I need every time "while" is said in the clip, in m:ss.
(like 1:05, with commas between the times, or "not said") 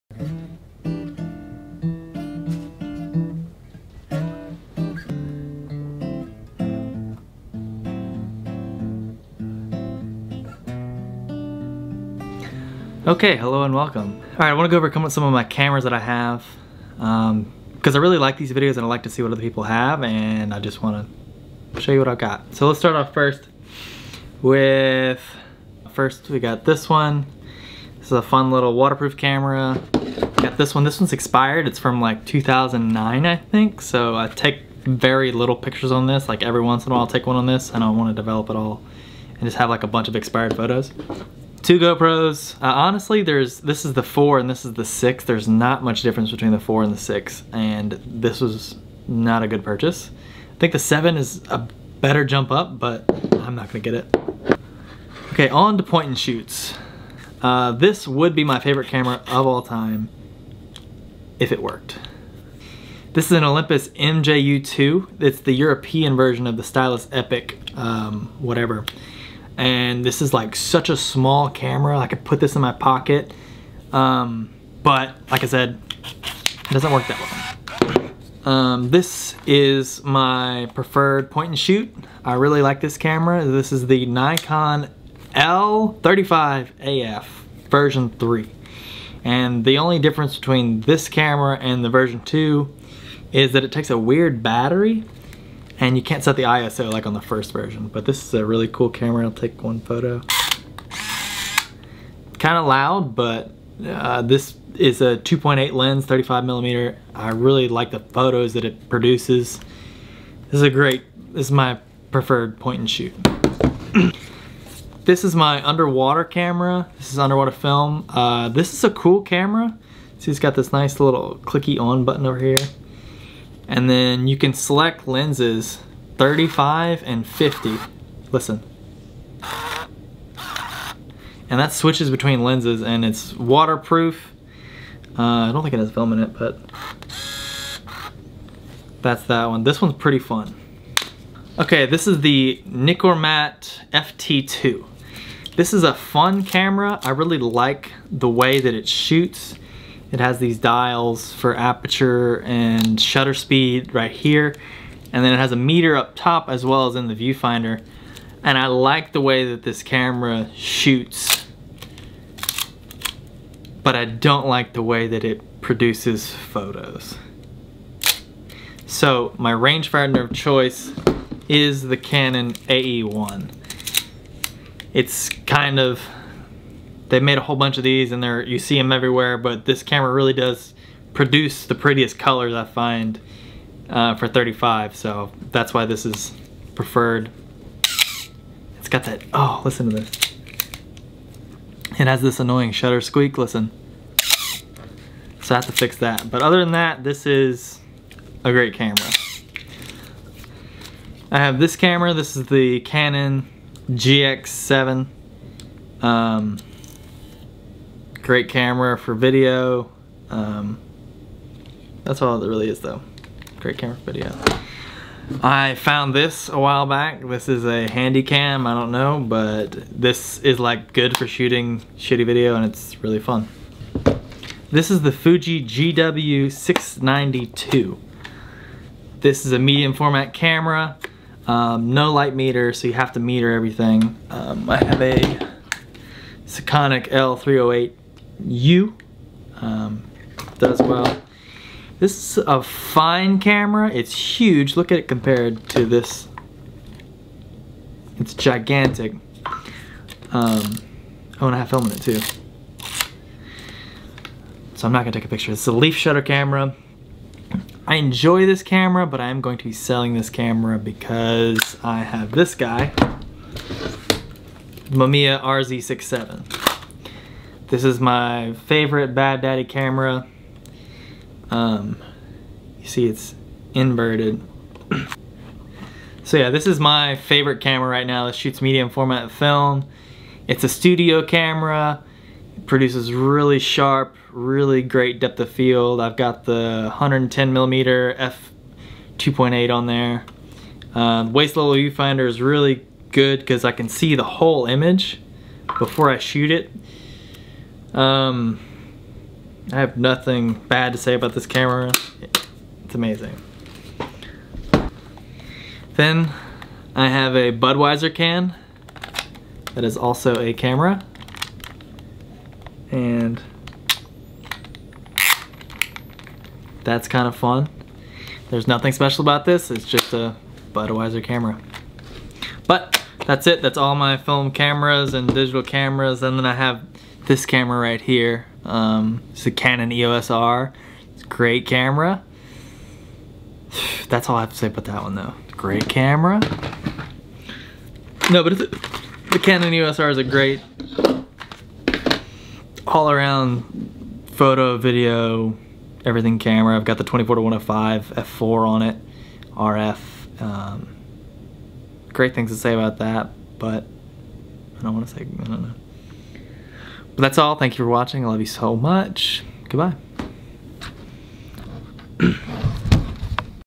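0:36, 3:36.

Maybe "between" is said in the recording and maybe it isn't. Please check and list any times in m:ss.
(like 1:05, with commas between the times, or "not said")
0:46, 1:30, 2:12.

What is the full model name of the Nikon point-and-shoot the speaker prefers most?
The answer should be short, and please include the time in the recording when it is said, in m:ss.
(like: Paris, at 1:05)
Nikon L35AF version 3, at 1:24.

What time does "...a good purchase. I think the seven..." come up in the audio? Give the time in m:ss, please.
0:49.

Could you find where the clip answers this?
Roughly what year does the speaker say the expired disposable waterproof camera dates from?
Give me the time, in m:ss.
0:32.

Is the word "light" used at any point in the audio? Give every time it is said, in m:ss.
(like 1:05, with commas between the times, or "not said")
3:52.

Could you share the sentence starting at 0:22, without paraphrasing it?
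So let's start off first with, first we got this one.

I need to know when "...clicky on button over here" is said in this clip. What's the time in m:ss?
2:01.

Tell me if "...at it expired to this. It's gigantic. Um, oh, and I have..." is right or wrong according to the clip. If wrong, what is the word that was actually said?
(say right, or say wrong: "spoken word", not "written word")
wrong: "compared", not "expired".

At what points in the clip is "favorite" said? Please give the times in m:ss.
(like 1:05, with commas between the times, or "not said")
0:58, 4:28, 4:37.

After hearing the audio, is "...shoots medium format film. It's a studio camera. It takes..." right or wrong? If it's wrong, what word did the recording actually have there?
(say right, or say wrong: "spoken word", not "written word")
wrong: "produces", not "takes".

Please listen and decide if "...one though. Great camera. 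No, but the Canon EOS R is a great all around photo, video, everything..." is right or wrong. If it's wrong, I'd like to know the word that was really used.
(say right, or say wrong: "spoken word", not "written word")
right.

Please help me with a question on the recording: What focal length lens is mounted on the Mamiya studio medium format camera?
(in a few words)
110 millimeter.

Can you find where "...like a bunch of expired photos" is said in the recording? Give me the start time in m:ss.
0:39.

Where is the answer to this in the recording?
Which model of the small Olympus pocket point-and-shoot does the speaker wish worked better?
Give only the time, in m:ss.
1:03.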